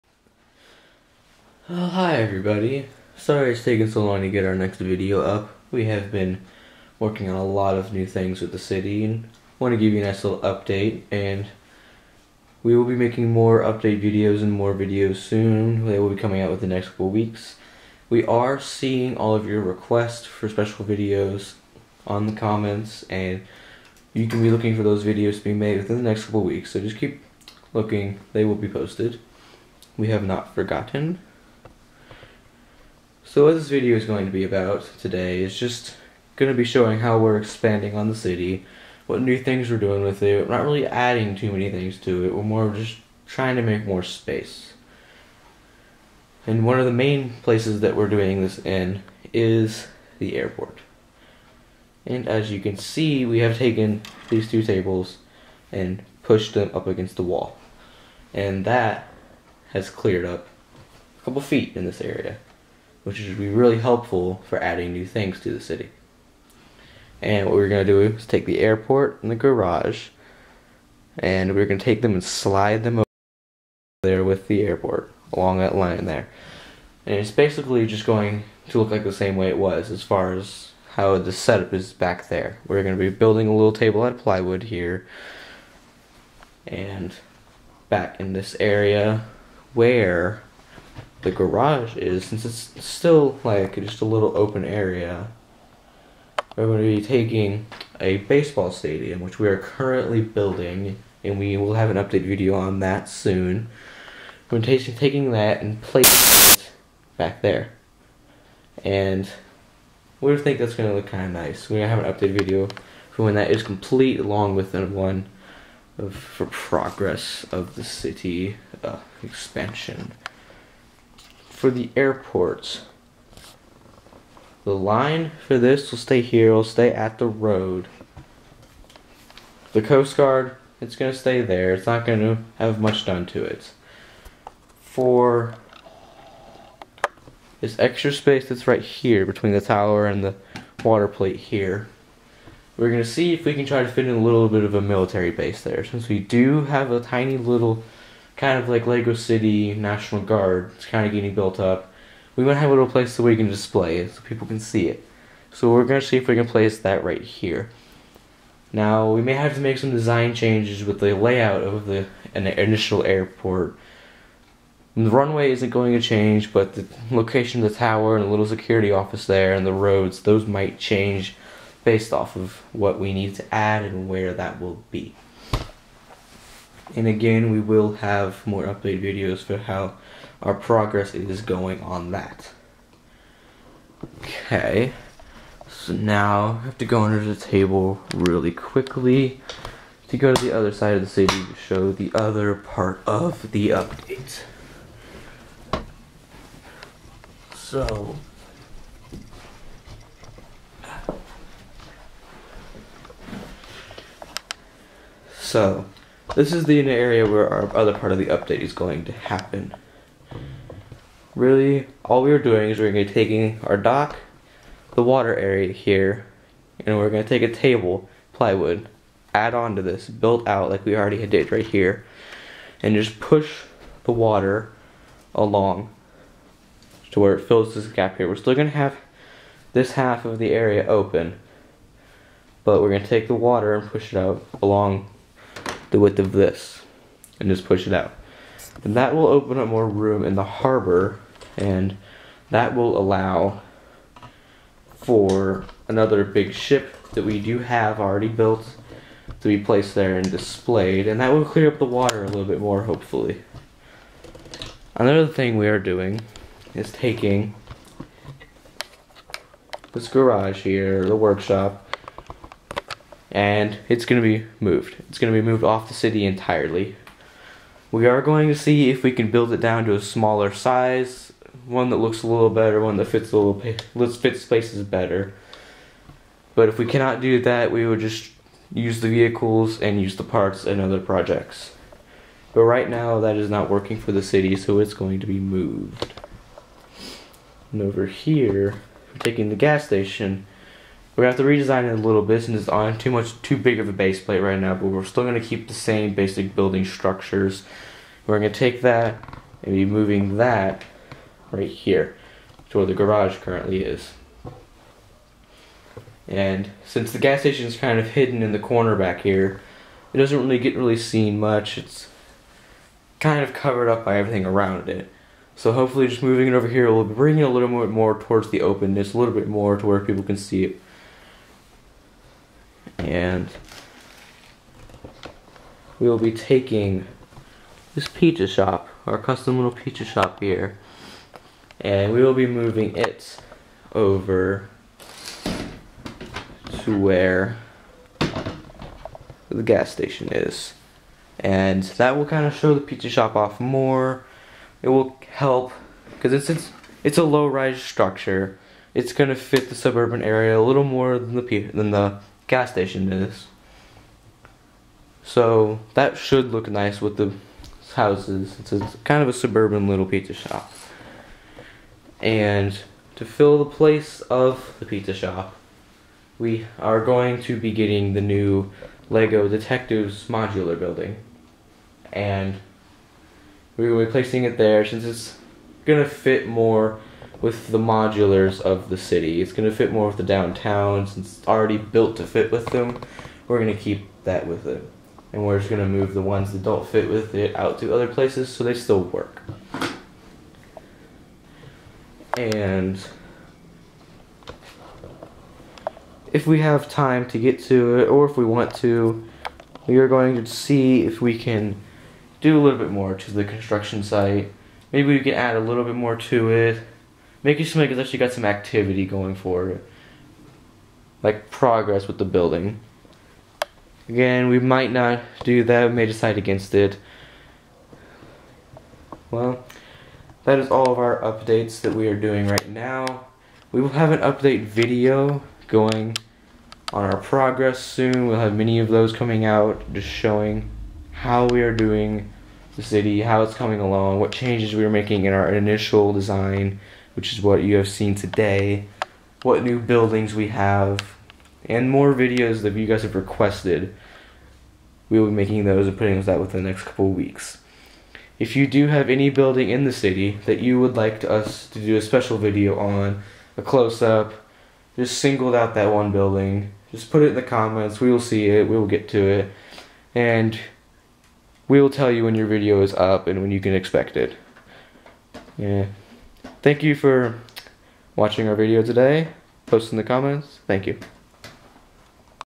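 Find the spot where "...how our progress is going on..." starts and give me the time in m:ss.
2:59.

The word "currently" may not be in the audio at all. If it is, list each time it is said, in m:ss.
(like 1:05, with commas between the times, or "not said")
1:39, 5:03.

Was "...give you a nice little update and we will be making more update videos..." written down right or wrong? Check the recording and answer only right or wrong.
right.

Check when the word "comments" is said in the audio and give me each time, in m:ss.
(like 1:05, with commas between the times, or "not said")
0:22, 7:37, 7:50.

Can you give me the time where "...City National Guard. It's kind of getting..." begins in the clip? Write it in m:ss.
2:29.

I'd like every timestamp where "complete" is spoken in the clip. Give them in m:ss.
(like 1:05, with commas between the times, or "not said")
1:53.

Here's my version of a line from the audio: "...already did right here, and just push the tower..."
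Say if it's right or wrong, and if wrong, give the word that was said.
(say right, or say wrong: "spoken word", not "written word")
wrong: "water", not "tower".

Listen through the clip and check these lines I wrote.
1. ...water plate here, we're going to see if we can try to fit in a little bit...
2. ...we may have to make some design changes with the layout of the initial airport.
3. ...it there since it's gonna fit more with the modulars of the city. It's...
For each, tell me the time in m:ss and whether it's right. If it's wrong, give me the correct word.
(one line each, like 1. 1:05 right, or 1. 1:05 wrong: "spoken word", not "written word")
1. 2:20 right
2. 2:39 right
3. 6:14 right.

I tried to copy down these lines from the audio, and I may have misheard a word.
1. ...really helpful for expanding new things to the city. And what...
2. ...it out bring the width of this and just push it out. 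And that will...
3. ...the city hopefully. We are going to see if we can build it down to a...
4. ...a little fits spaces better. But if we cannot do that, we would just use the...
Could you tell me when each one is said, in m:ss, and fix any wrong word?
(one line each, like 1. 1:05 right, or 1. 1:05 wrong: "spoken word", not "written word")
1. 1:03 wrong: "adding", not "expanding"
2. 3:54 wrong: "along", not "bring"
3. 4:25 wrong: "entirely", not "hopefully"
4. 4:33 right.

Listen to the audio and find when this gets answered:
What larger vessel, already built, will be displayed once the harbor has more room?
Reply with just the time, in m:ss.
4:06.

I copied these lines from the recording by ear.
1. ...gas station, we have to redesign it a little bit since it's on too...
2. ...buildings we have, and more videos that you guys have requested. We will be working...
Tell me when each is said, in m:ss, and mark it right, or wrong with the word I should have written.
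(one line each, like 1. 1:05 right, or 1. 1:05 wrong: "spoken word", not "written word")
1. 4:49 right
2. 7:19 wrong: "making", not "working".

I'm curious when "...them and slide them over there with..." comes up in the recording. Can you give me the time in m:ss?
1:12.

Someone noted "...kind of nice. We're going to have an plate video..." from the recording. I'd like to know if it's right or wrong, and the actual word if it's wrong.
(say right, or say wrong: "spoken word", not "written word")
wrong: "update", not "plate".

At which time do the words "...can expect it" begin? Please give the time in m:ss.
7:43.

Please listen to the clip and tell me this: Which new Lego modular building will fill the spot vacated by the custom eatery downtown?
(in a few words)
Lego Detectives.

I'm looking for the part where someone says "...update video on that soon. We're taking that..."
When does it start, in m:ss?
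1:41.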